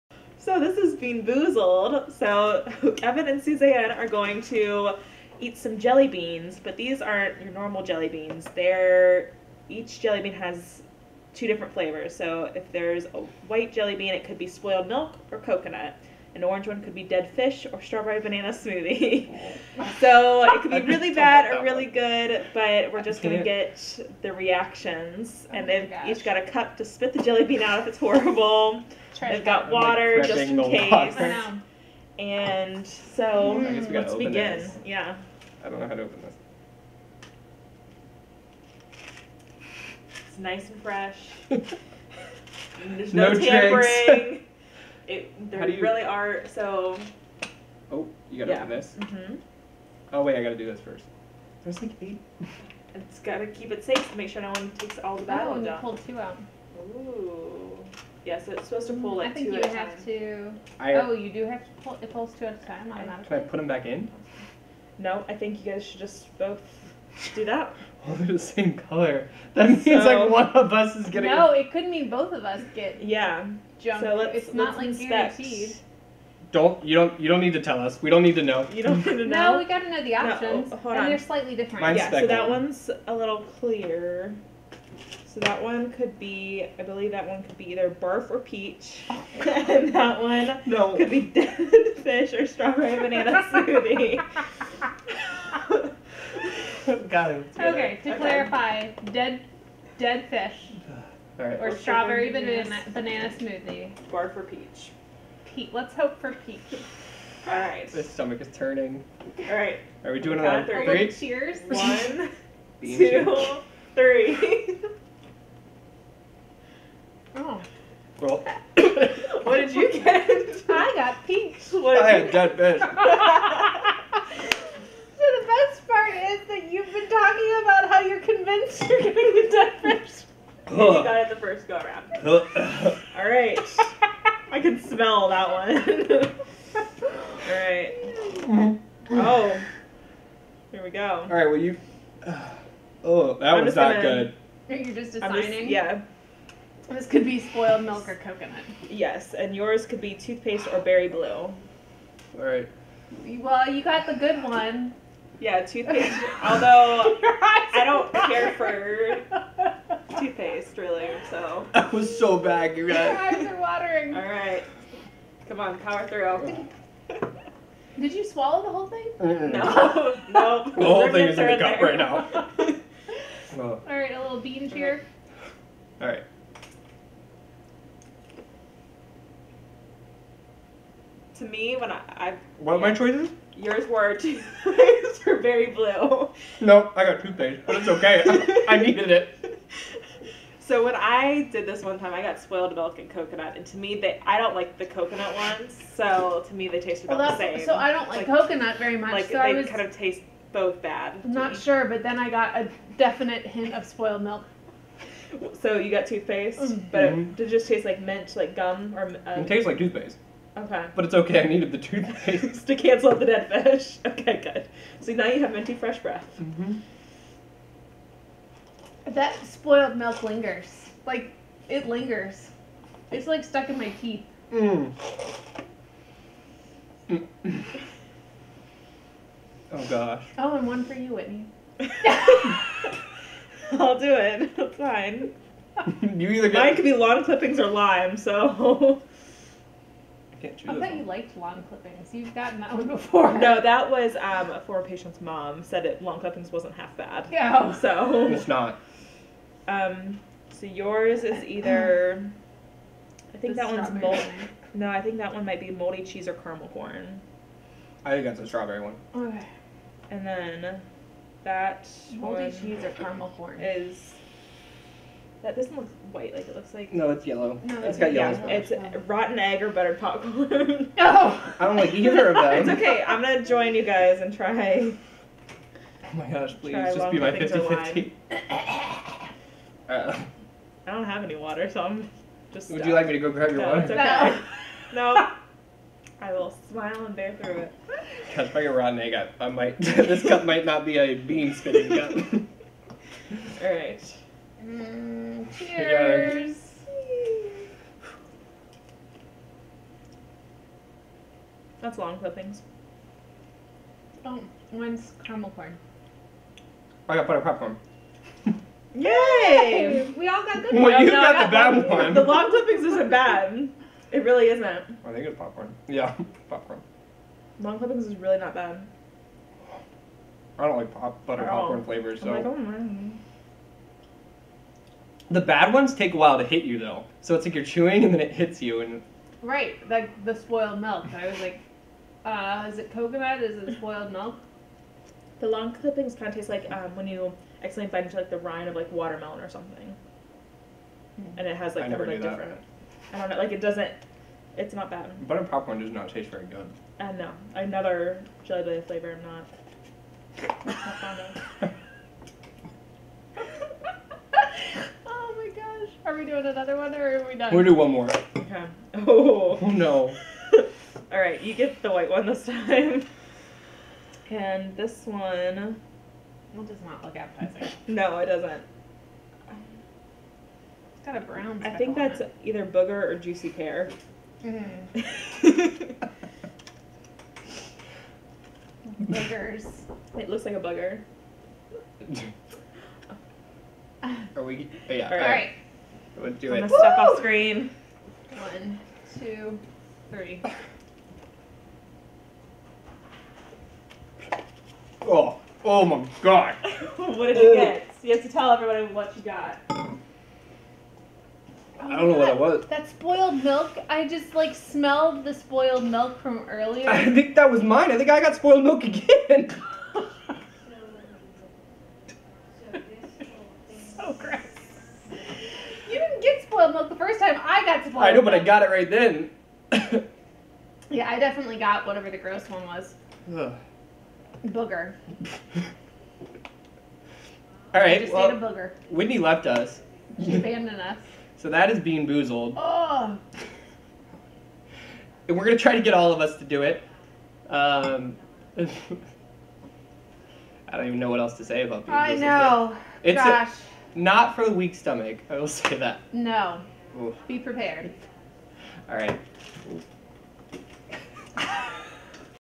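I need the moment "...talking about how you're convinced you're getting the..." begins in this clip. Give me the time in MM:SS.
02:07.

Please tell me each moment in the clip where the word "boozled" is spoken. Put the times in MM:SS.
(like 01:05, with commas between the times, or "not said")
00:01, 07:12, 07:22.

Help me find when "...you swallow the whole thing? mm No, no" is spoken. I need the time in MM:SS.
02:48.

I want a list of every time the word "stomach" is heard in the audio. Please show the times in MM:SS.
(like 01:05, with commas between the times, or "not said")
01:48, 07:24.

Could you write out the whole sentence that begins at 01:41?
Right, or strawberry banana, banana smoothie.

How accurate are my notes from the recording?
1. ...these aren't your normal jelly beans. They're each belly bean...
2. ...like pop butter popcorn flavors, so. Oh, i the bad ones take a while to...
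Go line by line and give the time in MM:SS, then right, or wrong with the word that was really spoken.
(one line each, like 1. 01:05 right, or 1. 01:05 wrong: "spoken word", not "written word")
1. 00:06 wrong: "jelly", not "belly"
2. 05:20 right.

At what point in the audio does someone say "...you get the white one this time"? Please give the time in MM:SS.
06:01.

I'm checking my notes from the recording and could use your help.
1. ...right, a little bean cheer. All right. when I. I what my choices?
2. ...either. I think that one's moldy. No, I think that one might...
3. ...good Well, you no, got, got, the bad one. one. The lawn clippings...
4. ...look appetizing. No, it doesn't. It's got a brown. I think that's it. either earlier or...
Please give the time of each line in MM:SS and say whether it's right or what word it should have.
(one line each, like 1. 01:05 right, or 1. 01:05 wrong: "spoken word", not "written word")
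1. 02:53 right
2. 04:11 right
3. 05:10 right
4. 06:07 wrong: "booger", not "earlier".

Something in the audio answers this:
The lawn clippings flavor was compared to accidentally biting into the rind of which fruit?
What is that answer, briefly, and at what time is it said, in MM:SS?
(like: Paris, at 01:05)
Watermelon, at 05:38.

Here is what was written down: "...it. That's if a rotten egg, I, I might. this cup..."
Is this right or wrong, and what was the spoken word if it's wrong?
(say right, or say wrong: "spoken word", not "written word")
right.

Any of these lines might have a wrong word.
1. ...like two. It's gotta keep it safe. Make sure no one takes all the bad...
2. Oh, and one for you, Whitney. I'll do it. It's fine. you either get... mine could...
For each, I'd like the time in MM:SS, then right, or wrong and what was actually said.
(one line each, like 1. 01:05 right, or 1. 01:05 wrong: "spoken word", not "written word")
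1. 00:51 wrong: "eight", not "two"
2. 03:50 right.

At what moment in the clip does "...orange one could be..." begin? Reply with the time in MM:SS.
00:16.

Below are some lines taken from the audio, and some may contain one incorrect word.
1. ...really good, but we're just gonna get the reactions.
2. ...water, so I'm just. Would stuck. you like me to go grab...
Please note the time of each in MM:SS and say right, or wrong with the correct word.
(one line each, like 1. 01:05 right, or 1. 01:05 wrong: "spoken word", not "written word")
1. 00:21 right
2. 04:41 right.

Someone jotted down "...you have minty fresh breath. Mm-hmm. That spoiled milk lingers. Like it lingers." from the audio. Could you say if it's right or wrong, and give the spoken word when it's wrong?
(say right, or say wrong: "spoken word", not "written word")
right.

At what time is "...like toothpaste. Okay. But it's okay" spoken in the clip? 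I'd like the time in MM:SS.
03:29.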